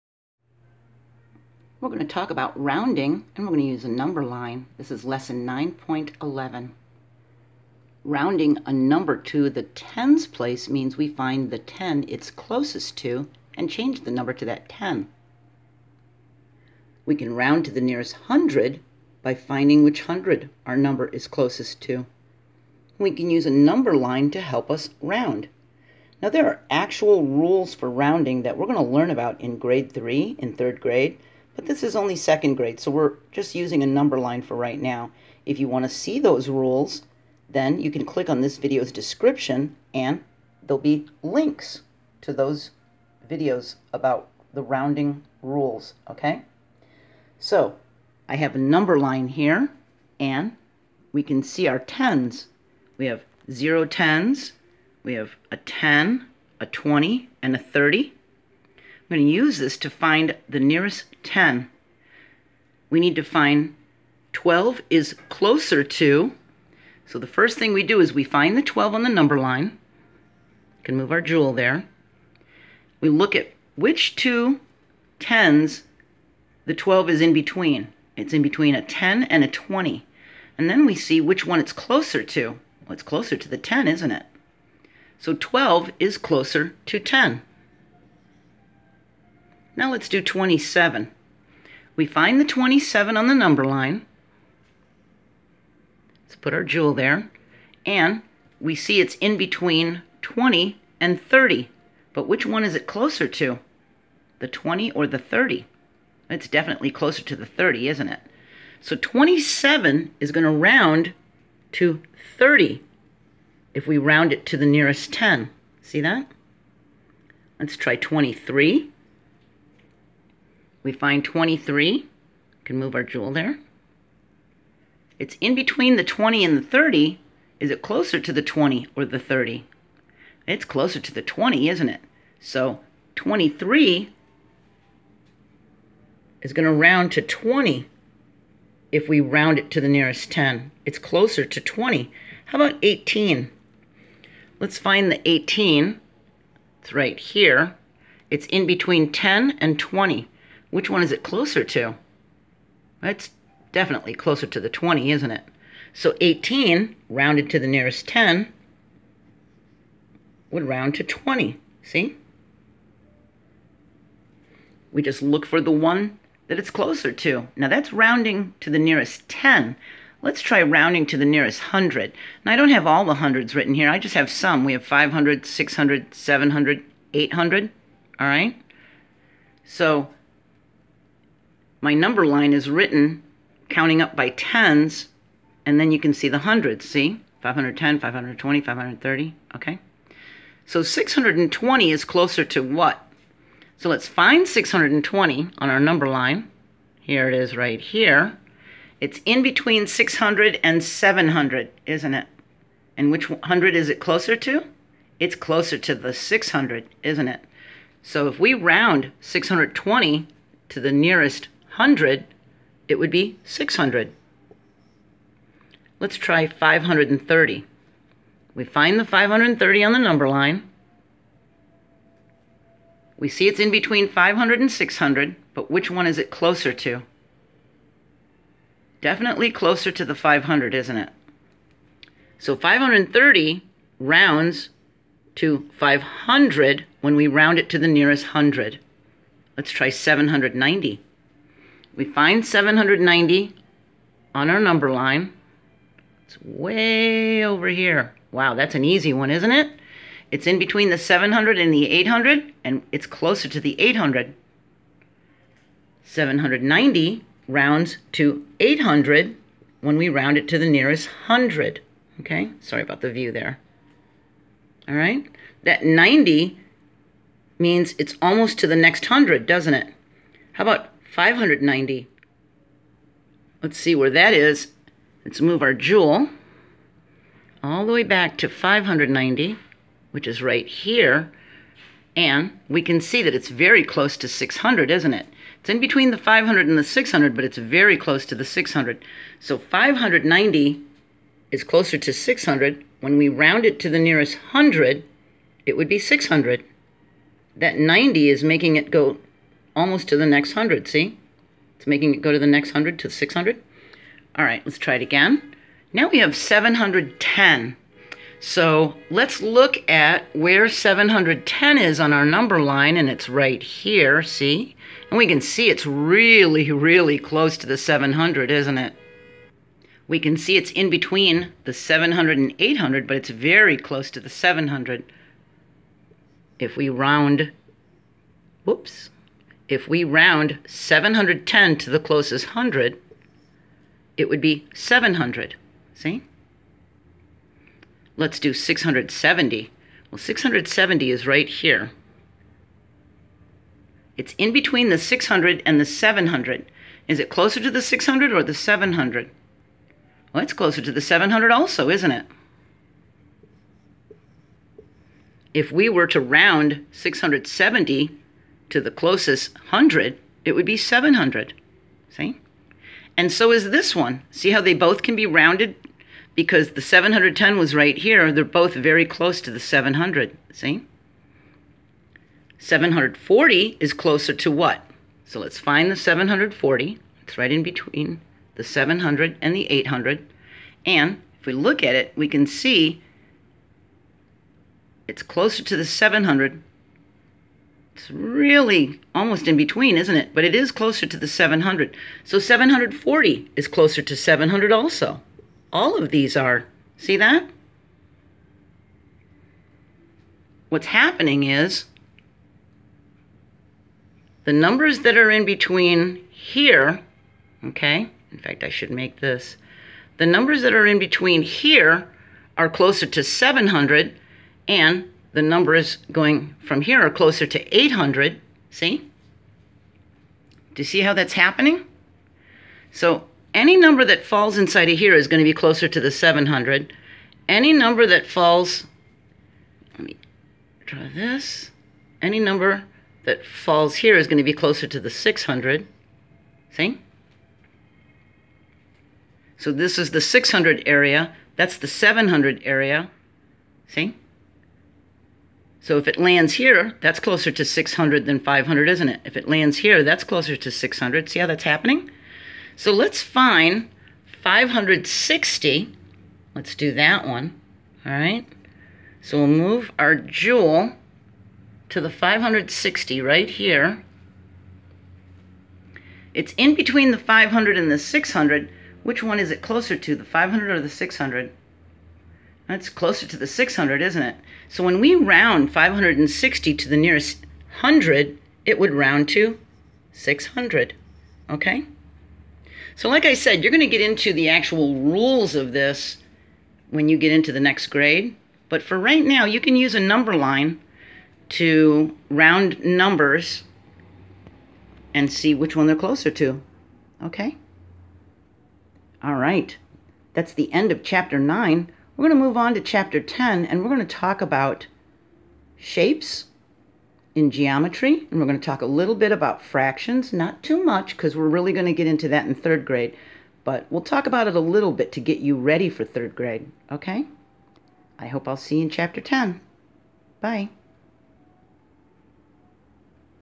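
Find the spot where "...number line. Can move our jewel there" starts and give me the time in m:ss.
1:09.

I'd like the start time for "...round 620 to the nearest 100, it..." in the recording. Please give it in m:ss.
3:28.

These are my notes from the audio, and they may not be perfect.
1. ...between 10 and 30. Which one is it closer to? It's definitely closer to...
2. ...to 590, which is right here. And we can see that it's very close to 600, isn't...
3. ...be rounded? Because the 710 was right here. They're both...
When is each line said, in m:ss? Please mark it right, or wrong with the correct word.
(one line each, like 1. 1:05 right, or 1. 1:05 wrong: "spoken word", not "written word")
1. 2:28 wrong: "20", not "30"
2. 4:38 right
3. 6:05 right.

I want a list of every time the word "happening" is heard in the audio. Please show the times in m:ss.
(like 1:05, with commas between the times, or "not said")
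6:40, 7:01, 7:31.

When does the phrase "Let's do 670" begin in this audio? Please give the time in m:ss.
5:38.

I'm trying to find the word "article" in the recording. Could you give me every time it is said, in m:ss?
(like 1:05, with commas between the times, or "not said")
not said.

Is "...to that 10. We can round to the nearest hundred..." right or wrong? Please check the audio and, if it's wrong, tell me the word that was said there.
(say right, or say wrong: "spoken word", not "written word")
right.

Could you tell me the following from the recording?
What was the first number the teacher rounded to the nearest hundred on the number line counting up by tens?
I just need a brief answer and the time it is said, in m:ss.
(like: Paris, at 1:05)
620, at 3:10.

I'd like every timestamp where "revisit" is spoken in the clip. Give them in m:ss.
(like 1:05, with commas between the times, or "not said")
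not said.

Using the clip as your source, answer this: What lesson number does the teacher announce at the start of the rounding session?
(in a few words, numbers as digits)
9.11.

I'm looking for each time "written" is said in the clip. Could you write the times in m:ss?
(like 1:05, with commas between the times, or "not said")
2:53, 3:02.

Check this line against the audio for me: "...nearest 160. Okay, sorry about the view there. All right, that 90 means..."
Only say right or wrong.
wrong.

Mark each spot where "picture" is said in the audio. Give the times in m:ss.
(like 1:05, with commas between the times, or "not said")
not said.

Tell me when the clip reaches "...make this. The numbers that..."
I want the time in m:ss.
6:48.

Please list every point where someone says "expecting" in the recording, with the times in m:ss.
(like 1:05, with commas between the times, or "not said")
not said.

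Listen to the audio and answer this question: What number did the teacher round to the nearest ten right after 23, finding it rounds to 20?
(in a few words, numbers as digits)
18.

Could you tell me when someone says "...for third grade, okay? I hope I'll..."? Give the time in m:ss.
8:35.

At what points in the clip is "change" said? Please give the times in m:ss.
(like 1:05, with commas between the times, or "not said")
0:13.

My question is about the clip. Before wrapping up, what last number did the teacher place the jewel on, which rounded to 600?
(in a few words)
560.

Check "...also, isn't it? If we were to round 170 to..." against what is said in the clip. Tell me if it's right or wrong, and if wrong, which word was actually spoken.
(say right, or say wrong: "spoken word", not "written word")
wrong: "670", not "170".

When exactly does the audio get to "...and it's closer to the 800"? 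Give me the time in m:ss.
4:12.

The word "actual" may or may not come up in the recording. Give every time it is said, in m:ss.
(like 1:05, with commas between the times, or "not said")
0:26, 8:04.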